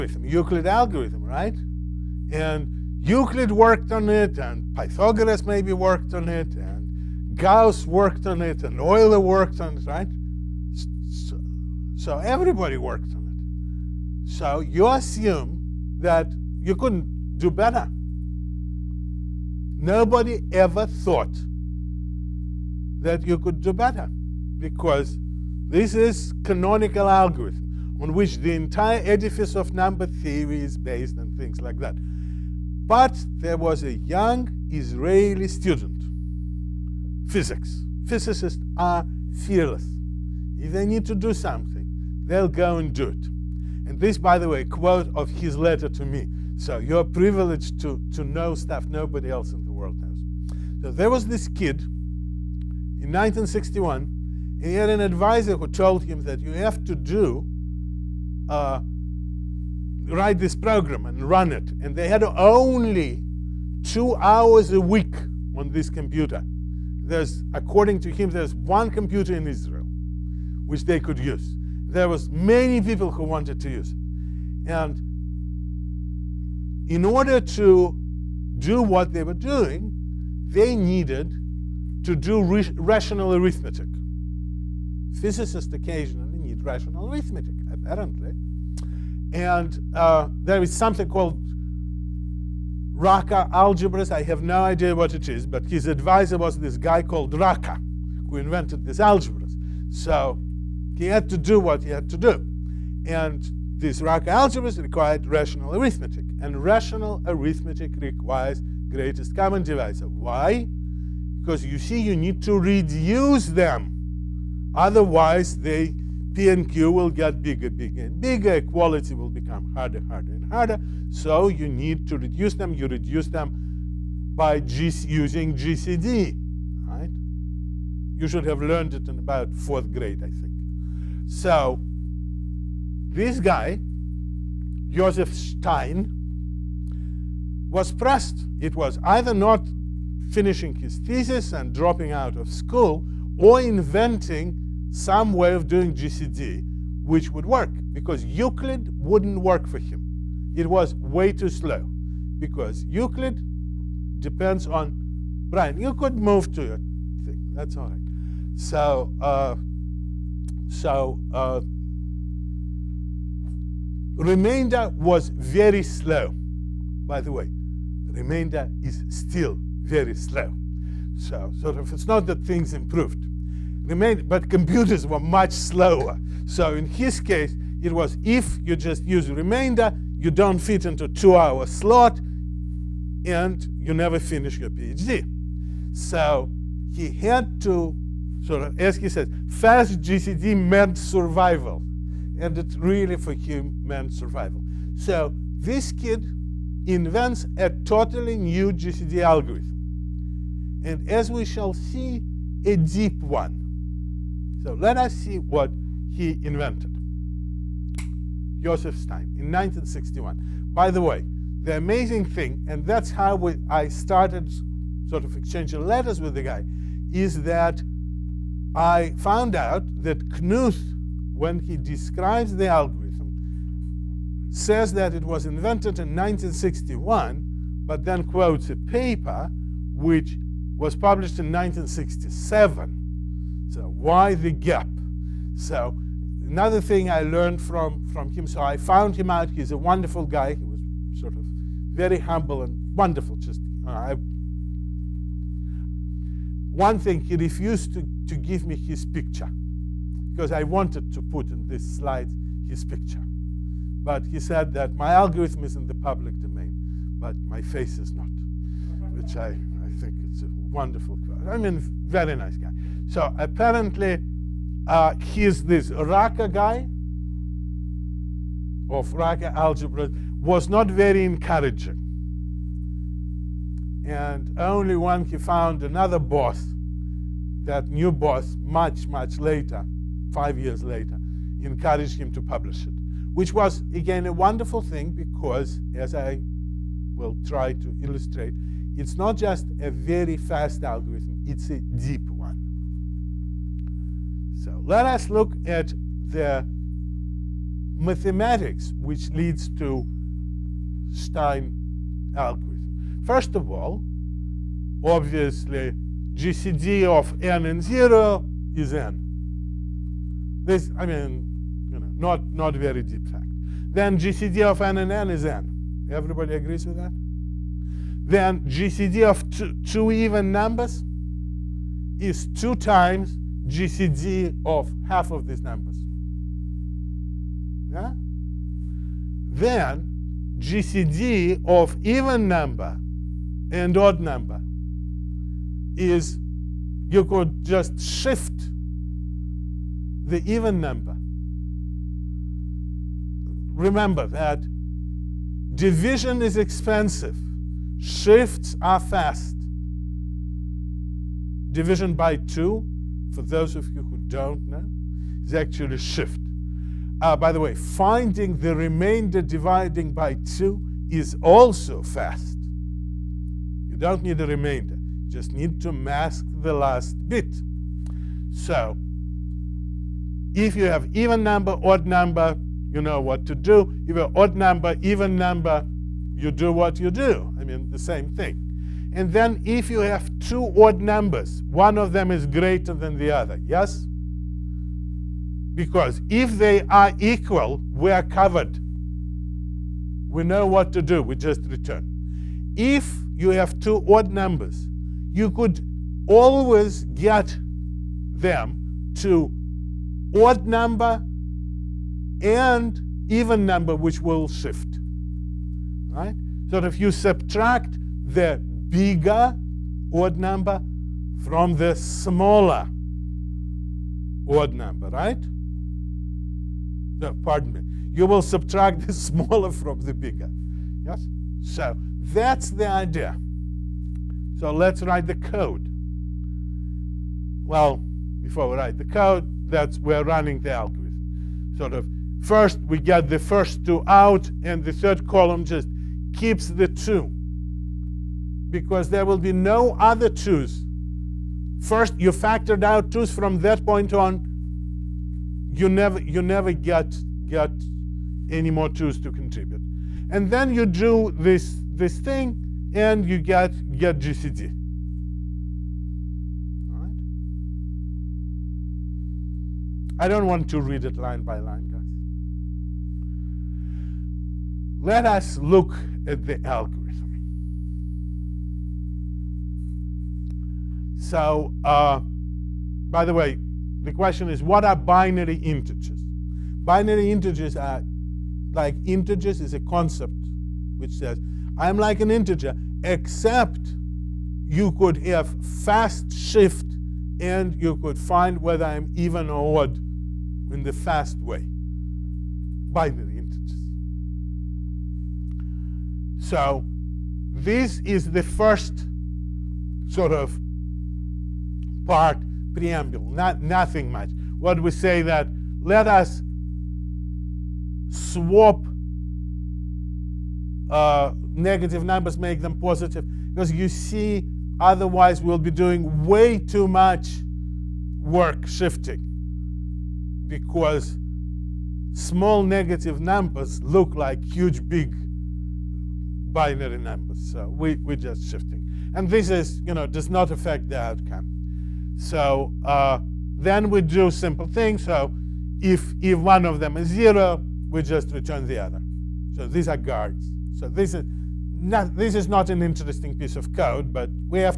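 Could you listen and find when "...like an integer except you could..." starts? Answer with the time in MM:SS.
08:01.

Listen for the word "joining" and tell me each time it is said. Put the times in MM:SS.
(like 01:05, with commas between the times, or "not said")
not said.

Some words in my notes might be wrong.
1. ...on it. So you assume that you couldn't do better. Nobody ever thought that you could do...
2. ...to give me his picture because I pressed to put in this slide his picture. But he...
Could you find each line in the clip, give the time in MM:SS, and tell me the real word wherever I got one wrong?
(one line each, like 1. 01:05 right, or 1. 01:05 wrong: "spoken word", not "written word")
1. 00:13 right
2. 04:08 wrong: "wanted", not "pressed".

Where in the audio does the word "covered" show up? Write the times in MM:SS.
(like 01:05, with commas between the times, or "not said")
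06:28.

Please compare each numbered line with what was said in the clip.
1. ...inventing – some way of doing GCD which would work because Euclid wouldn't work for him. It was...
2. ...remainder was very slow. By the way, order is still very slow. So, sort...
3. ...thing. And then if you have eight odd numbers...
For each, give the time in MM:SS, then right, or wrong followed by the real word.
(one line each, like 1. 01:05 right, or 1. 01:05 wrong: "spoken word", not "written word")
1. 02:23 right
2. 02:44 wrong: "remainder", not "order"
3. 06:18 wrong: "two", not "eight".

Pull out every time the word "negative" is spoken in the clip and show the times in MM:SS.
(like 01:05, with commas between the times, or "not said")
08:31, 08:42.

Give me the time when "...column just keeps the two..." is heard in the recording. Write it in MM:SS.
07:15.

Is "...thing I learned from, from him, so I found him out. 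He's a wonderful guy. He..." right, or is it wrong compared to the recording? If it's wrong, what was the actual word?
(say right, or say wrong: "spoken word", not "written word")
right.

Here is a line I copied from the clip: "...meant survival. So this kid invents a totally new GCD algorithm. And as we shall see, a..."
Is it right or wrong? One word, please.
right.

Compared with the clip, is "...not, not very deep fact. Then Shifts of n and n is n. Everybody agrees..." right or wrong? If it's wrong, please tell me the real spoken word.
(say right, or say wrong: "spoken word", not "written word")
wrong: "GCD", not "Shifts".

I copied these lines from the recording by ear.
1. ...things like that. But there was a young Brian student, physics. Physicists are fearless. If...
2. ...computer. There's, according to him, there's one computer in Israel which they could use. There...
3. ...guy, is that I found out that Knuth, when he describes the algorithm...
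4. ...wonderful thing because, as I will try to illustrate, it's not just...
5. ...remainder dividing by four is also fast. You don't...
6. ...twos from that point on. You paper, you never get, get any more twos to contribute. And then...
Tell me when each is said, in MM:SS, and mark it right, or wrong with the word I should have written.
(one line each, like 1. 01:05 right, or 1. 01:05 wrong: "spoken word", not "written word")
1. 00:31 wrong: "Israeli", not "Brian"
2. 01:05 right
3. 03:36 right
4. 04:44 right
5. 05:58 wrong: "two", not "four"
6. 07:23 wrong: "never", not "paper".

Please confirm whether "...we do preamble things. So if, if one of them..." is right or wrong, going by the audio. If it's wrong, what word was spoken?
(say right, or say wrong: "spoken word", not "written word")
wrong: "simple", not "preamble".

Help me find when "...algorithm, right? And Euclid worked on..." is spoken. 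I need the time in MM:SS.
00:00.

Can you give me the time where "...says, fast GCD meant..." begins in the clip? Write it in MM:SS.
03:09.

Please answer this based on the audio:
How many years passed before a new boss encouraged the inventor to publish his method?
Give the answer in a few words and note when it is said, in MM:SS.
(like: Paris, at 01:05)
5, at 04:40.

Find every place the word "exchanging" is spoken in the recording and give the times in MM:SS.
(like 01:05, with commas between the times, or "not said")
03:35.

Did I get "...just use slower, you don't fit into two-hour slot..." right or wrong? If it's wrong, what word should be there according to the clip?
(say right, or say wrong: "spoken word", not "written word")
wrong: "remainder", not "slower".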